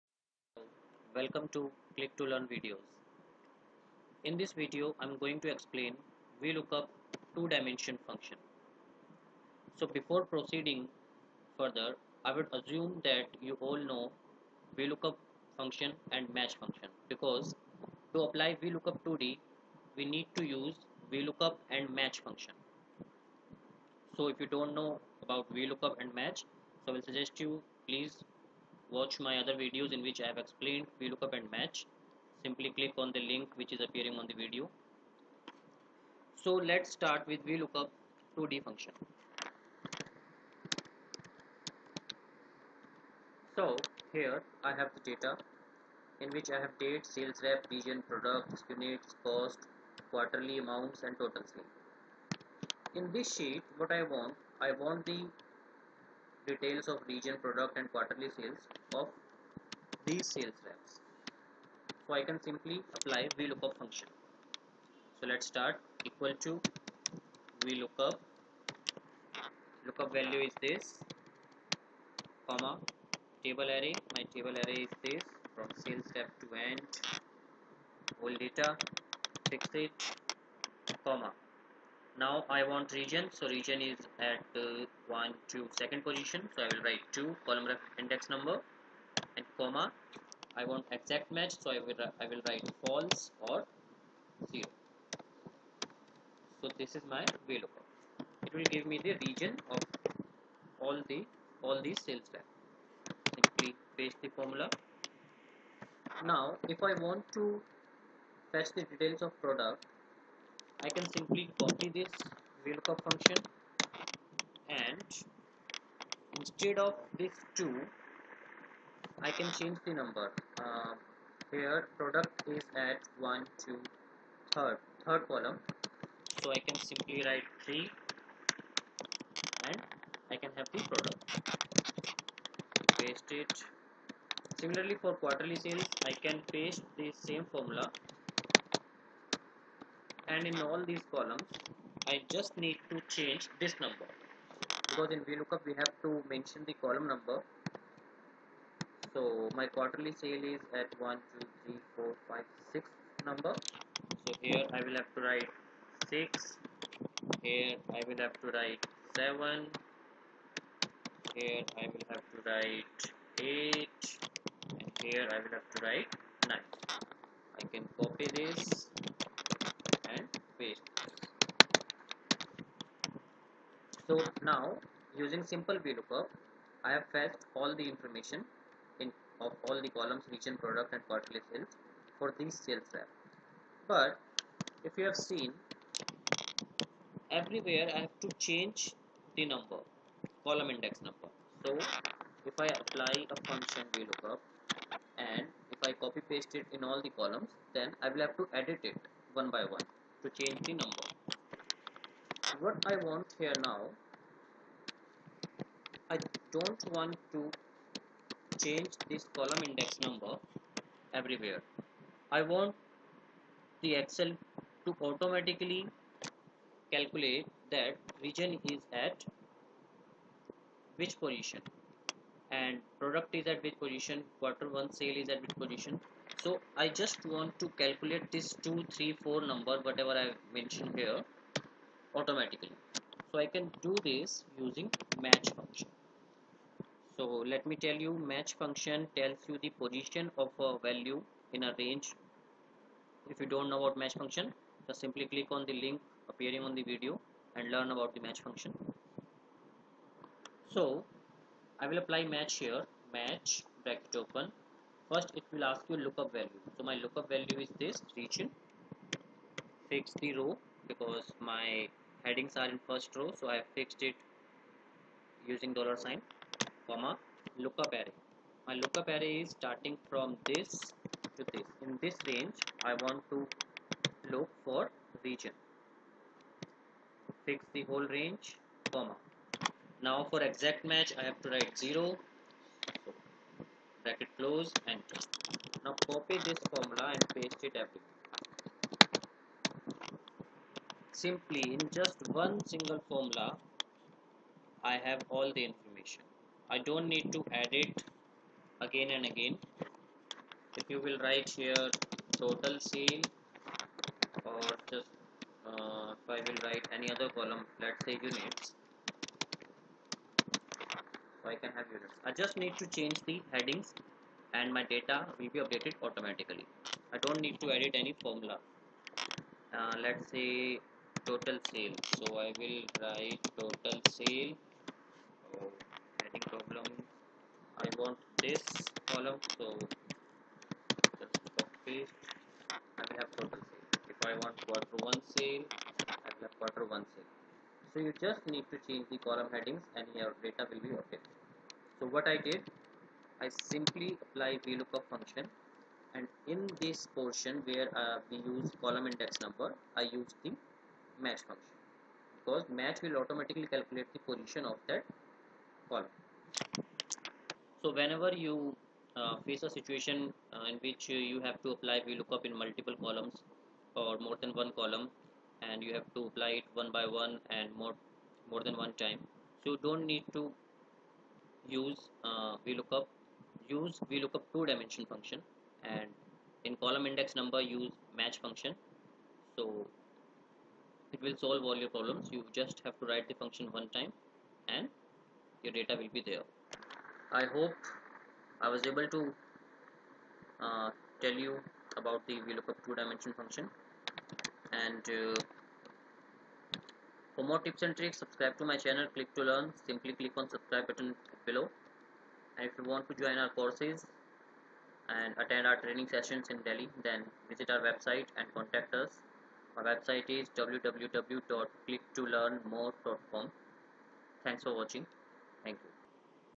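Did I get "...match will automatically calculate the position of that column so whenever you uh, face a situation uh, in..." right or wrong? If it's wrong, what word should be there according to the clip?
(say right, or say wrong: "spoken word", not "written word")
right.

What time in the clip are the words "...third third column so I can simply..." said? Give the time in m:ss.
2:04.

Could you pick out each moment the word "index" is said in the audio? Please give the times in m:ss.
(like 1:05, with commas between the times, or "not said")
1:27, 3:10, 3:29, 5:49, 6:17.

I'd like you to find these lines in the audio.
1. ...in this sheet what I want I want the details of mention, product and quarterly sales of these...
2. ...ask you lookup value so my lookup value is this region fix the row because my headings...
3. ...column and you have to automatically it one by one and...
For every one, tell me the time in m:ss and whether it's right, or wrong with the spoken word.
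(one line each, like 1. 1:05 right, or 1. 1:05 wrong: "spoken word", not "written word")
1. 0:52 wrong: "region", not "mention"
2. 4:15 right
3. 6:04 wrong: "apply", not "automatically".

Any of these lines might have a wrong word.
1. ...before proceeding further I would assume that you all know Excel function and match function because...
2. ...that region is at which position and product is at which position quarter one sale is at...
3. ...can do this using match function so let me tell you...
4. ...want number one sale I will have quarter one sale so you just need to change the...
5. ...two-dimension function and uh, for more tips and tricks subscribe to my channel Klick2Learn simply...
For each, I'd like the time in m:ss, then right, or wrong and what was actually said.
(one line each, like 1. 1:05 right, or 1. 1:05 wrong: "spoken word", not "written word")
1. 0:09 wrong: "VLOOKUP", not "Excel"
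2. 3:37 right
3. 3:53 right
4. 5:34 wrong: "quarter", not "number"
5. 6:32 right.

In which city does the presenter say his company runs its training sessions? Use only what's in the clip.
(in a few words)
Delhi.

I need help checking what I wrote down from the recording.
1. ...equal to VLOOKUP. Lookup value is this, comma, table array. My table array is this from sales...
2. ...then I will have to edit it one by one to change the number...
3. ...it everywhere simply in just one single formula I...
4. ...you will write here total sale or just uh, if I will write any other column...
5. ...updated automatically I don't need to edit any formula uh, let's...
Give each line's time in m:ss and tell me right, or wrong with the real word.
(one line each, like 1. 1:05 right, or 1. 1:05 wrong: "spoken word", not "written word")
1. 1:06 right
2. 3:17 right
3. 4:47 right
4. 5:00 right
5. 5:15 right.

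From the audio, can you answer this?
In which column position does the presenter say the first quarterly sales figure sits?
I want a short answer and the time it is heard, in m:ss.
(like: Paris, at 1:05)
6, at 2:32.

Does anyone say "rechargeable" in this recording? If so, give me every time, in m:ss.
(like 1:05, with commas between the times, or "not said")
not said.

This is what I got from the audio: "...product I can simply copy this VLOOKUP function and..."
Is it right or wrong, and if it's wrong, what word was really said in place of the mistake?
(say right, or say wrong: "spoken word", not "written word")
right.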